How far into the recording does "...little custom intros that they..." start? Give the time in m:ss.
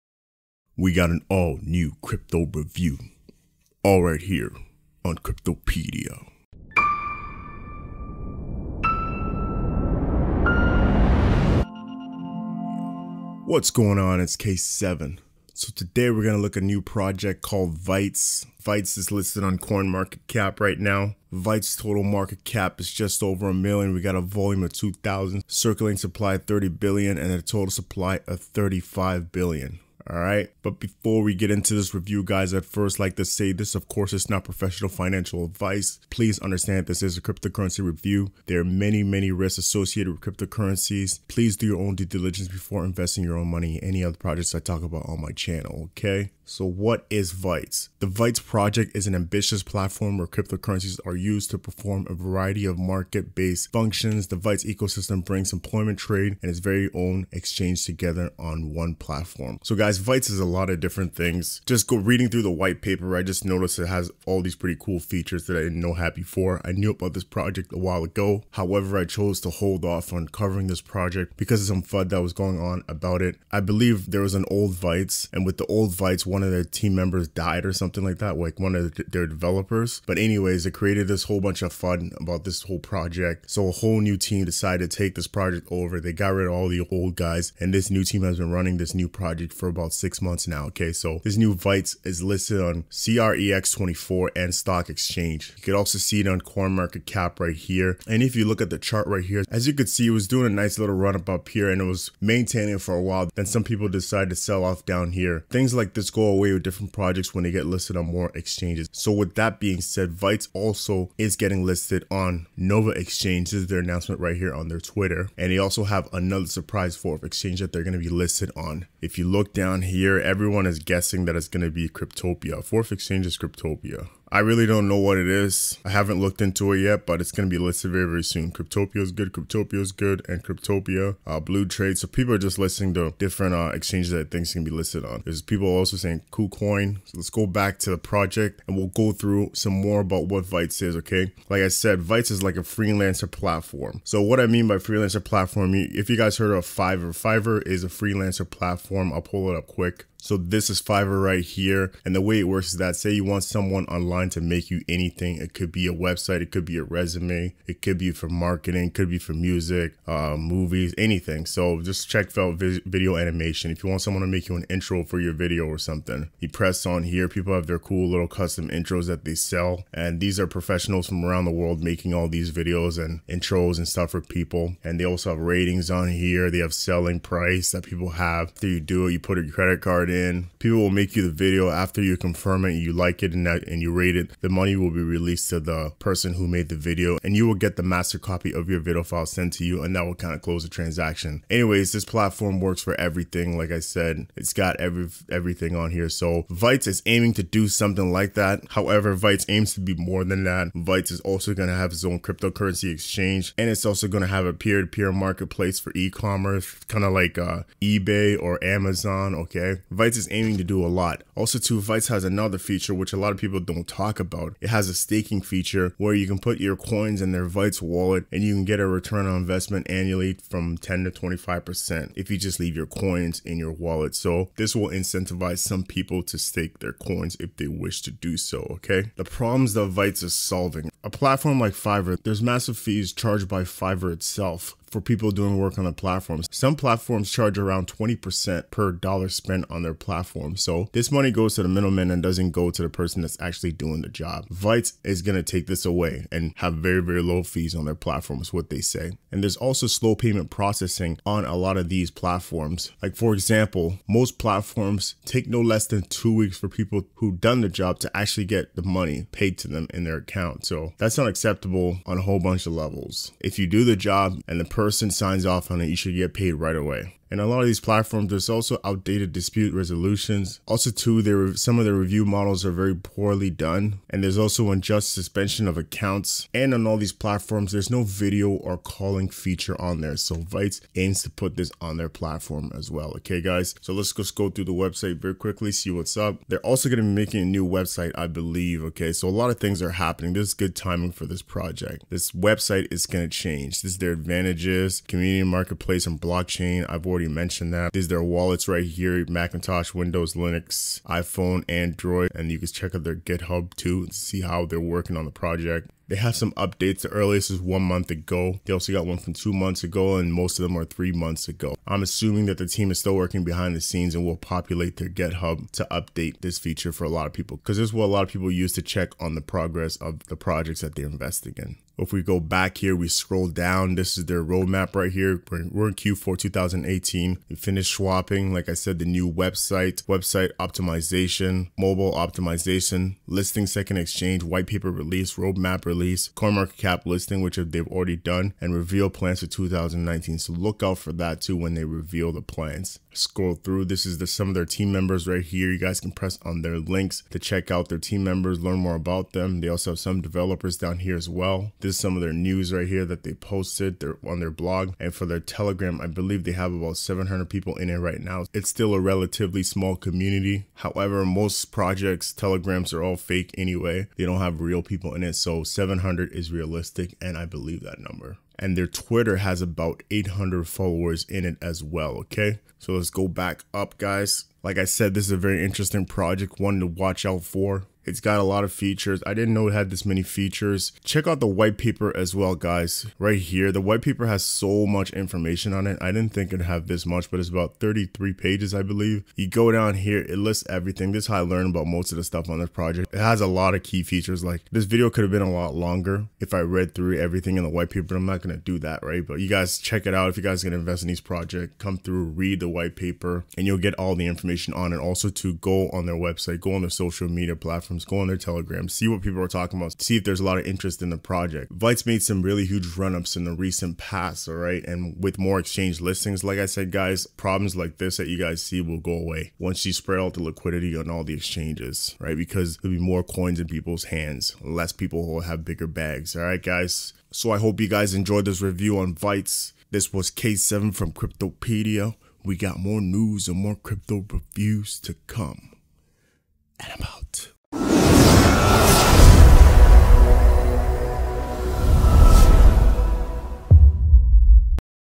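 2:48.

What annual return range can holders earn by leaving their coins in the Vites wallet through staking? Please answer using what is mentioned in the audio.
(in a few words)
10 to 25%.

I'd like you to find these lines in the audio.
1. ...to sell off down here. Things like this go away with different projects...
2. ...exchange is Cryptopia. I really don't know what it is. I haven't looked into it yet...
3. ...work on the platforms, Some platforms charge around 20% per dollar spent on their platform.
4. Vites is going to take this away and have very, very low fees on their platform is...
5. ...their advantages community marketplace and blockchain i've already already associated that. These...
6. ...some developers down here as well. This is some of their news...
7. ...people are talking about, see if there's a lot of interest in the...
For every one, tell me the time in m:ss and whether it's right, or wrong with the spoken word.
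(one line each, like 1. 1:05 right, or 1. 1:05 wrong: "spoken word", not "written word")
1. 1:44 right
2. 2:02 right
3. 3:55 right
4. 4:04 right
5. 4:53 wrong: "mentioned", not "associated"
6. 5:49 right
7. 6:49 right.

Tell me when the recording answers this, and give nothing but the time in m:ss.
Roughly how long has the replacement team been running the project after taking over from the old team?
1:29.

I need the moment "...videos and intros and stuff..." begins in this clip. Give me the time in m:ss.
2:52.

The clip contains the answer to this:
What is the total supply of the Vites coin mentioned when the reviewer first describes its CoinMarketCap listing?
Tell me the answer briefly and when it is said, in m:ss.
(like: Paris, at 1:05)
35 billion, at 0:28.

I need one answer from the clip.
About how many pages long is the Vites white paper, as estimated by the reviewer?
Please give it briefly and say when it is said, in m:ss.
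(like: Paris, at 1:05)
33, at 6:27.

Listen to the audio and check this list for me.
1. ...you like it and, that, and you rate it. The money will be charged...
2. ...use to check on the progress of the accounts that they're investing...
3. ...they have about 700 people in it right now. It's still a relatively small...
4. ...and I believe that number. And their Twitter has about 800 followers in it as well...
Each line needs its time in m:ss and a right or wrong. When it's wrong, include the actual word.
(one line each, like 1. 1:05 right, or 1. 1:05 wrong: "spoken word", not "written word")
1. 3:02 wrong: "released", not "charged"
2. 5:18 wrong: "projects", not "accounts"
3. 5:56 right
4. 6:07 right.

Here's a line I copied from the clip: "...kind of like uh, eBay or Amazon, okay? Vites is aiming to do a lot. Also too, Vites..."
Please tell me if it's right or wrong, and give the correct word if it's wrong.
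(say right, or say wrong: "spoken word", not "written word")
right.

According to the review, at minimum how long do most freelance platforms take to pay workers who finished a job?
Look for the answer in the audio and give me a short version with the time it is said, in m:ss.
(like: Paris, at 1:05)
2 weeks, at 4:16.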